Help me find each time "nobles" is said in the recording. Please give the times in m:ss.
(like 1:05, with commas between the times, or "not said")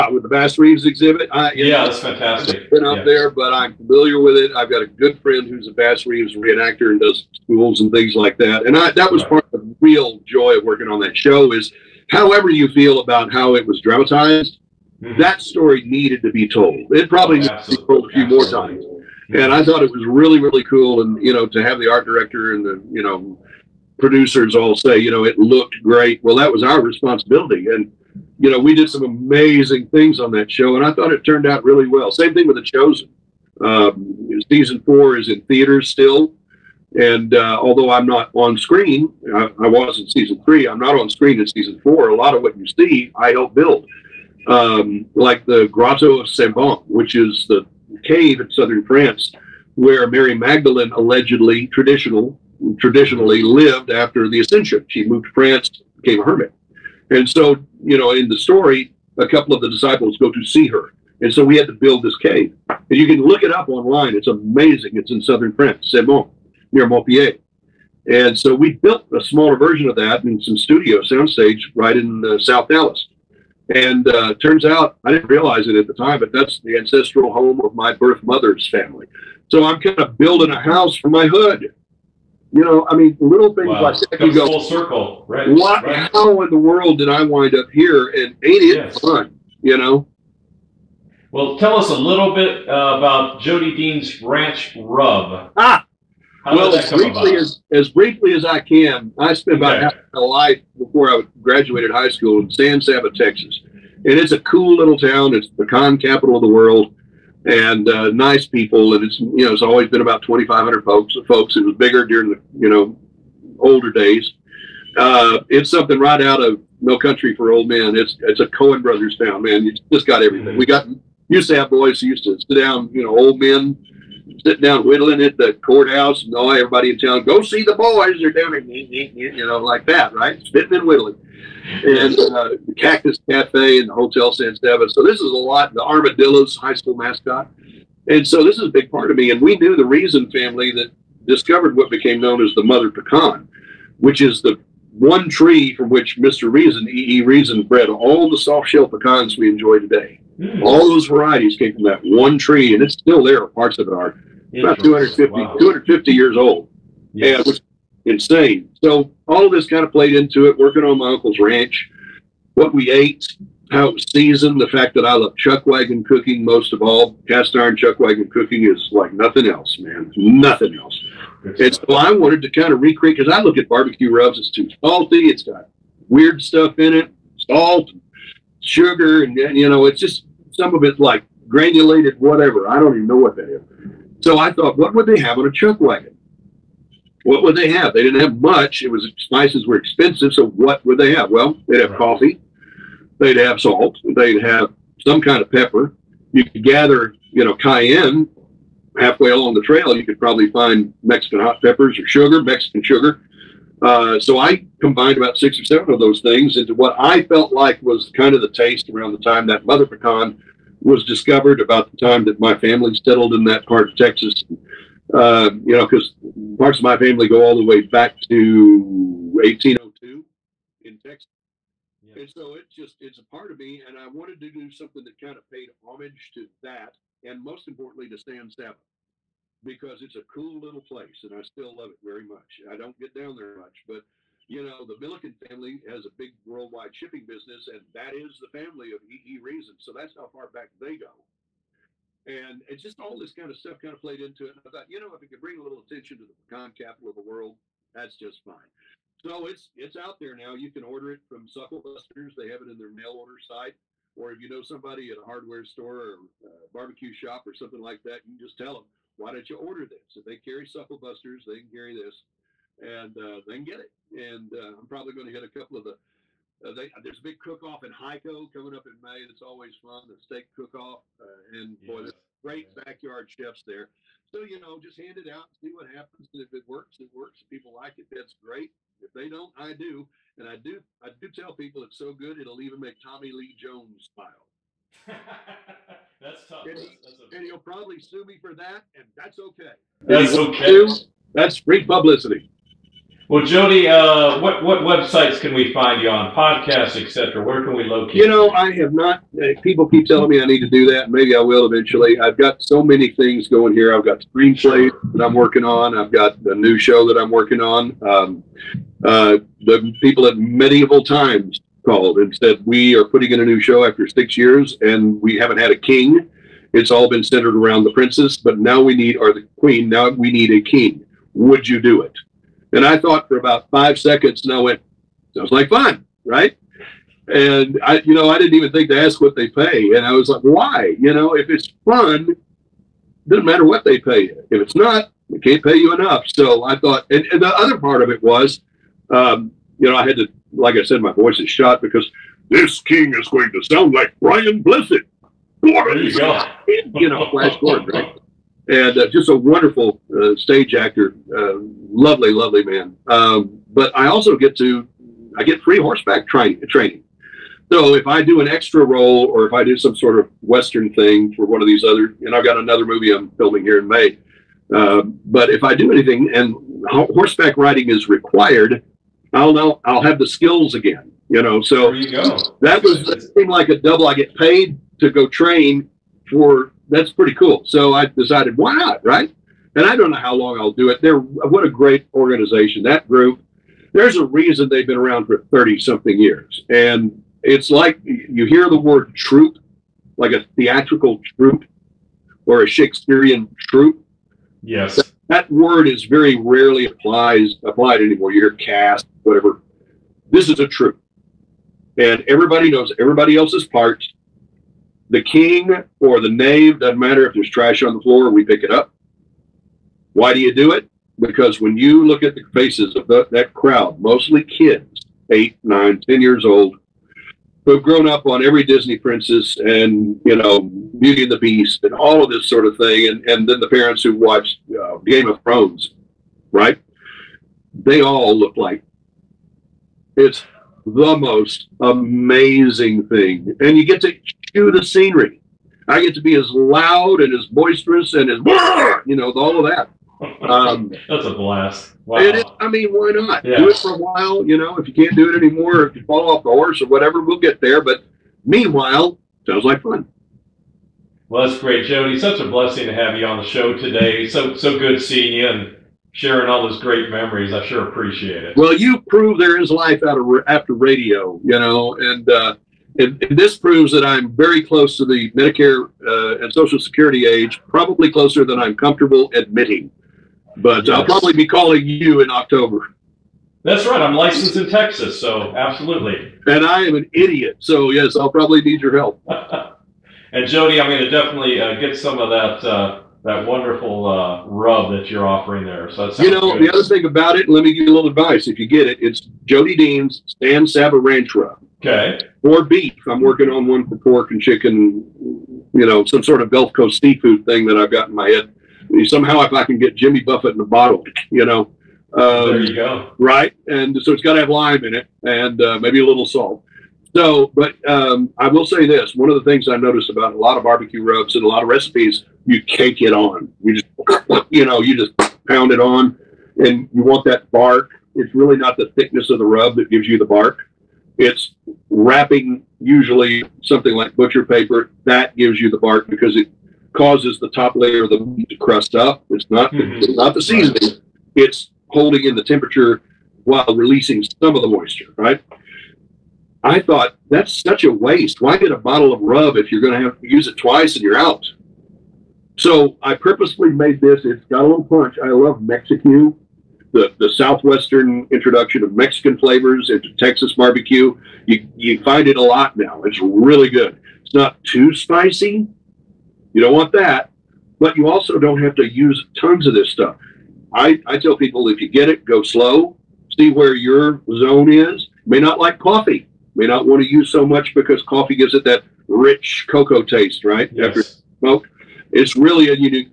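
not said.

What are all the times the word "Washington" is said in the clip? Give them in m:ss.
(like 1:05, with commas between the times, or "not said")
not said.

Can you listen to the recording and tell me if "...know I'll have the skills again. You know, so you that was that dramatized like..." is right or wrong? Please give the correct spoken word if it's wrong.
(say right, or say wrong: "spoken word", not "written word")
wrong: "seemed", not "dramatized".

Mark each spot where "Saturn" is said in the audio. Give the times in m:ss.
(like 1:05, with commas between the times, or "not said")
not said.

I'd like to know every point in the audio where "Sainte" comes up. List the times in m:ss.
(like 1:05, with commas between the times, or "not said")
0:46, 1:05.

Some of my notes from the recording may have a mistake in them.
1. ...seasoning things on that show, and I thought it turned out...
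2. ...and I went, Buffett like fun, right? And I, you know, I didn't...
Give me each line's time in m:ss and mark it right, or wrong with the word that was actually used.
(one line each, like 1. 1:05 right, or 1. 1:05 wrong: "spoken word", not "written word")
1. 0:29 wrong: "amazing", not "seasoning"
2. 5:24 wrong: "Sounds", not "Buffett".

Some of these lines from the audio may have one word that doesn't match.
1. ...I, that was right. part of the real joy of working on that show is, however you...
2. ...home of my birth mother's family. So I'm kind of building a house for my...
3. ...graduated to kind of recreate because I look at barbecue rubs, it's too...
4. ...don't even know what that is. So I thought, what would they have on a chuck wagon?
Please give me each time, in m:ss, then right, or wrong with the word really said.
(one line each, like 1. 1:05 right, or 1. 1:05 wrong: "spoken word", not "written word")
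1. 0:08 right
2. 1:17 right
3. 2:52 wrong: "wanted", not "graduated"
4. 3:02 right.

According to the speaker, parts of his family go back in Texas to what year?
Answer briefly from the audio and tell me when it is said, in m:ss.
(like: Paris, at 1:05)
1802, at 3:39.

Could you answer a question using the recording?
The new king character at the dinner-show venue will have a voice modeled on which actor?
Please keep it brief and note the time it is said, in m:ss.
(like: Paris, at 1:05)
Brian Blessed, at 5:44.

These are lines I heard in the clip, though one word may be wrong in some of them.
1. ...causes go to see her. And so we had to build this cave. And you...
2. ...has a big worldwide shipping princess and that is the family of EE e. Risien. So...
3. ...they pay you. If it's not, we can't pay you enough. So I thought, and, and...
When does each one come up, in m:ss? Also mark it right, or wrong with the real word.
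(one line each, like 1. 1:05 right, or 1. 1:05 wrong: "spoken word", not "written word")
1. 0:59 wrong: "disciples", not "causes"
2. 3:55 wrong: "business", not "princess"
3. 5:33 right.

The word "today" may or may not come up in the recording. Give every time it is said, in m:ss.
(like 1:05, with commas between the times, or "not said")
2:29, 7:33.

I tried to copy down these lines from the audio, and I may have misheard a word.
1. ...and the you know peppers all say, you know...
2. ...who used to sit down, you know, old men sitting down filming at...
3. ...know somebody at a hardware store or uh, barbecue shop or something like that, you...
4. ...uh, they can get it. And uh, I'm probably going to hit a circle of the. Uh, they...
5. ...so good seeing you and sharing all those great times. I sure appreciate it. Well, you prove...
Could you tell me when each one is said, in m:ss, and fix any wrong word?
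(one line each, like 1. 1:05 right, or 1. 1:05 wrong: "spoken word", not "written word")
1. 0:22 wrong: "producers", not "peppers"
2. 2:02 wrong: "whittling", not "filming"
3. 4:14 right
4. 4:23 wrong: "couple", not "circle"
5. 7:34 wrong: "memories", not "times".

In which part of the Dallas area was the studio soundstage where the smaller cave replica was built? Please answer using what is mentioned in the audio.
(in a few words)
South Dallas.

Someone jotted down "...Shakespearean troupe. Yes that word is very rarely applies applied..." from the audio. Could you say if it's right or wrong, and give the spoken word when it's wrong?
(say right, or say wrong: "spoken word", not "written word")
right.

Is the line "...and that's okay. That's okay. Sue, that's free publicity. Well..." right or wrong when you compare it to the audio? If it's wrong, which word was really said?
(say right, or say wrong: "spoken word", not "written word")
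right.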